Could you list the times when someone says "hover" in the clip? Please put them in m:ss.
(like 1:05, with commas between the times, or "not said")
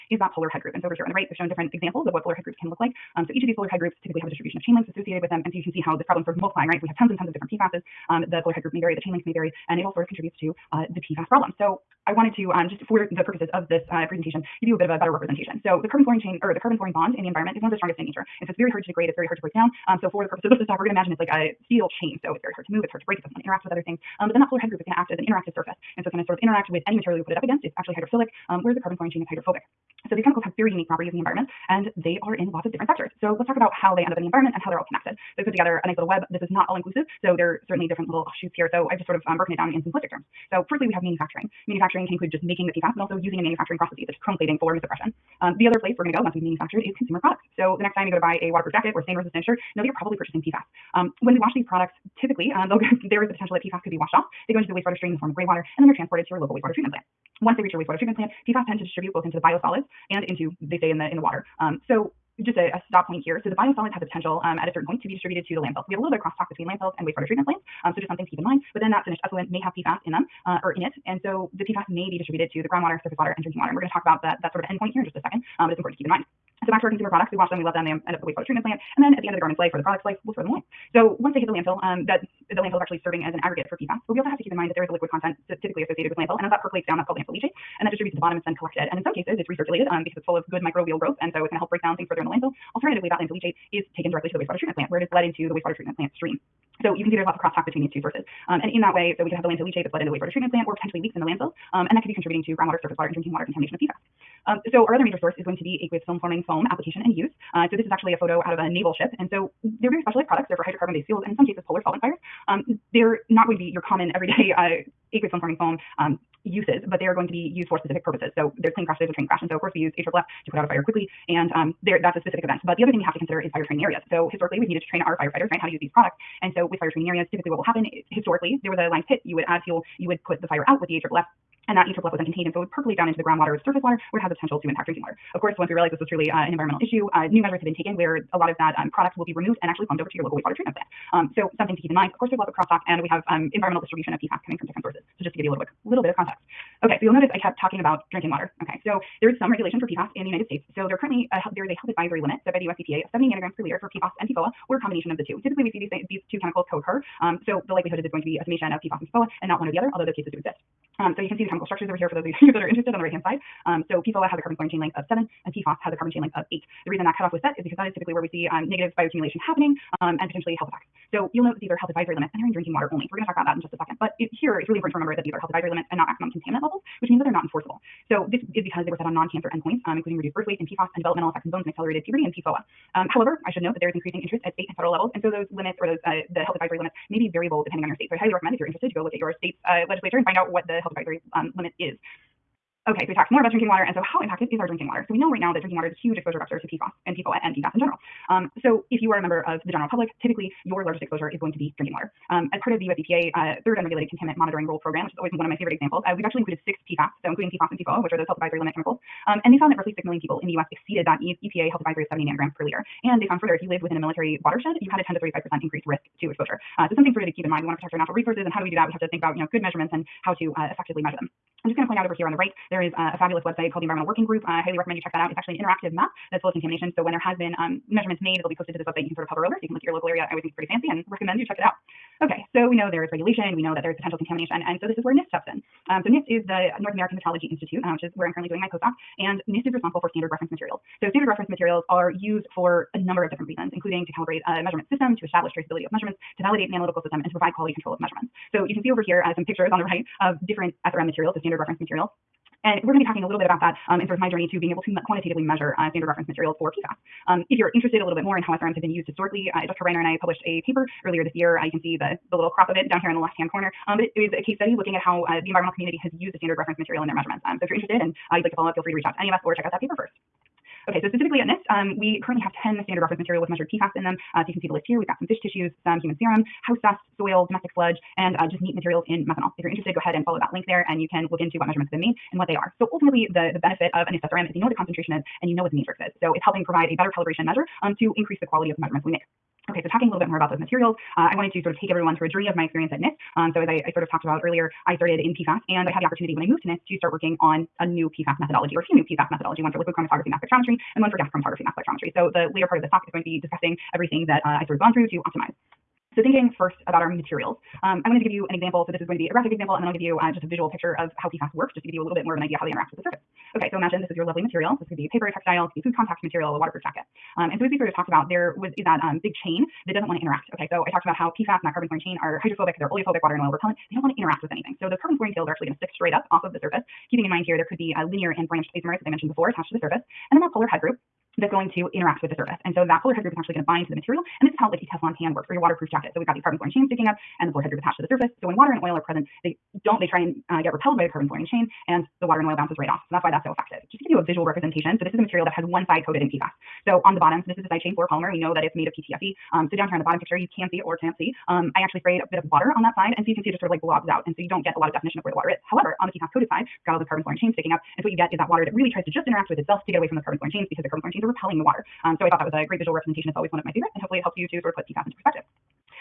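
3:49.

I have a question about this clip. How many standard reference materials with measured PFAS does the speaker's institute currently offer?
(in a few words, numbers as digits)
10.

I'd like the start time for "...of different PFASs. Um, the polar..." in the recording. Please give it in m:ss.
0:07.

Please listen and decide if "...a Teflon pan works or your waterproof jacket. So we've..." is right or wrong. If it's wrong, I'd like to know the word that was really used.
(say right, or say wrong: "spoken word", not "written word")
right.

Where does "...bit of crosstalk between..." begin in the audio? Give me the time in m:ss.
1:06.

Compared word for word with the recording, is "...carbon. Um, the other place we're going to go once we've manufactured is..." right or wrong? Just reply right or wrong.
wrong.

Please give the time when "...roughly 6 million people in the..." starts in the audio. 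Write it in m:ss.
3:29.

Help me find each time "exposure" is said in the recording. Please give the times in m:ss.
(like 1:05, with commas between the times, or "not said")
3:16, 3:21, 3:36.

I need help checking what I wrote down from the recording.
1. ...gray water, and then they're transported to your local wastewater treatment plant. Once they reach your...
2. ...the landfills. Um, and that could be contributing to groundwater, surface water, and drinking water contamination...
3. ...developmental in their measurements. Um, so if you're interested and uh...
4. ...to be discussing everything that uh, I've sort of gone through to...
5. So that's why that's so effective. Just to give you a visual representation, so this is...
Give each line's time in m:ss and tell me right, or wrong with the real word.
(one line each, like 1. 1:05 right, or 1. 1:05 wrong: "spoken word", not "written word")
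1. 0:55 right
2. 1:41 right
3. 4:26 wrong: "material", not "developmental"
4. 5:03 right
5. 5:43 right.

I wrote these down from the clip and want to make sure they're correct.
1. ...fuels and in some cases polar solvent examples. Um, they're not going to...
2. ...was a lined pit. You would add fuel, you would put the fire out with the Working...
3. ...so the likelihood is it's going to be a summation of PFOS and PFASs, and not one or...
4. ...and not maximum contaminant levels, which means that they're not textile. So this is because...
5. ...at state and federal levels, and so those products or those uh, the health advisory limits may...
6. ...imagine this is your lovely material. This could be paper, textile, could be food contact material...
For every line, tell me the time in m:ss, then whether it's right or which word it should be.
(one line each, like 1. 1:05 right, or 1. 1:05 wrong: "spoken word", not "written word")
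1. 1:51 wrong: "fires", not "examples"
2. 2:08 wrong: "AFFF", not "Working"
3. 2:37 wrong: "PFOA", not "PFASs"
4. 2:55 wrong: "enforceable", not "textile"
5. 3:04 wrong: "limits", not "products"
6. 5:13 right.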